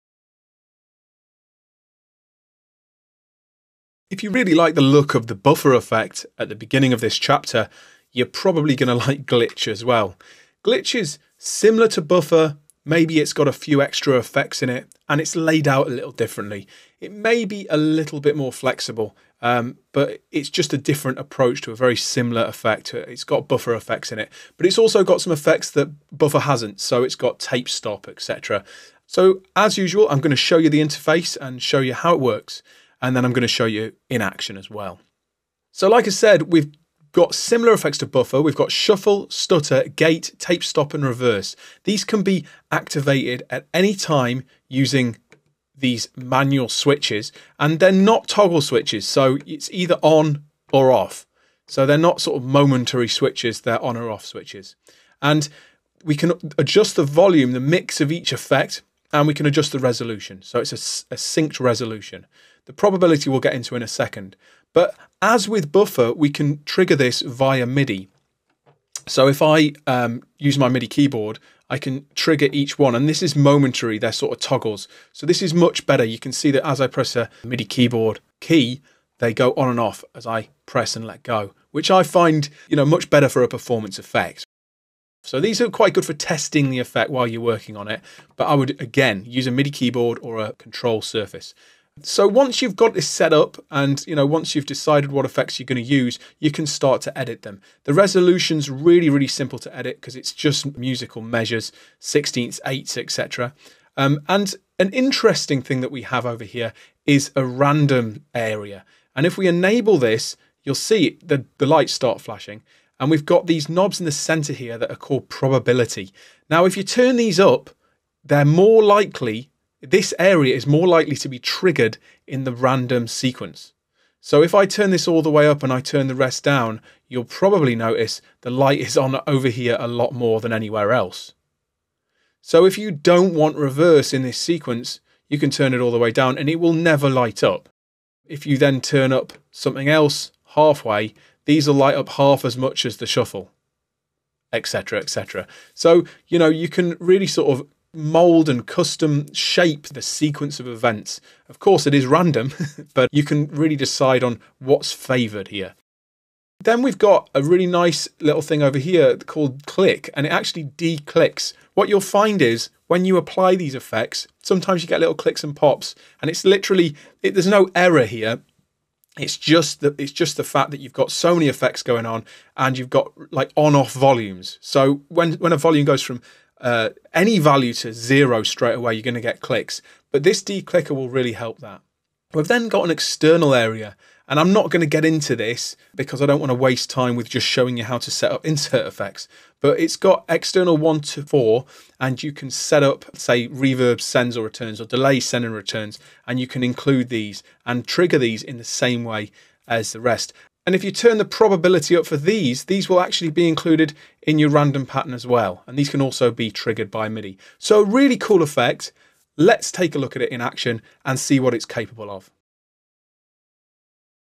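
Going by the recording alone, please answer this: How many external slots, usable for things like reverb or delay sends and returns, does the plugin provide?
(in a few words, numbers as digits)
4.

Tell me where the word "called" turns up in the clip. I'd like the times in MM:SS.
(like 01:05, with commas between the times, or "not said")
01:54, 02:39.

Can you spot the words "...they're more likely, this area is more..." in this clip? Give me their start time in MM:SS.
01:58.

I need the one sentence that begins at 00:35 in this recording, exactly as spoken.
So like I said, we've got similar effects to Buffre.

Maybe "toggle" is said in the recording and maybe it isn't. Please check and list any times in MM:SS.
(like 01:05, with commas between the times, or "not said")
00:48, 01:14.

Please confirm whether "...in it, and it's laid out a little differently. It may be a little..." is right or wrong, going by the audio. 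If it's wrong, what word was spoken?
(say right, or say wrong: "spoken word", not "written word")
right.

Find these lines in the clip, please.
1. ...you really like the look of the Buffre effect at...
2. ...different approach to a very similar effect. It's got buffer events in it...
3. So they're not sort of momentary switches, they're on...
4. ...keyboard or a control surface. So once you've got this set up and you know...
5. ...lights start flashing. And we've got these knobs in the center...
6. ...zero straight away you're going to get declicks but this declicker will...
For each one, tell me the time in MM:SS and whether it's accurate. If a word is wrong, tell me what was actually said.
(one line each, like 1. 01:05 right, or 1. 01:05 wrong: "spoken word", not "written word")
1. 00:04 right
2. 00:20 wrong: "effects", not "events"
3. 00:51 right
4. 01:29 right
5. 01:51 right
6. 02:57 wrong: "clicks", not "declicks".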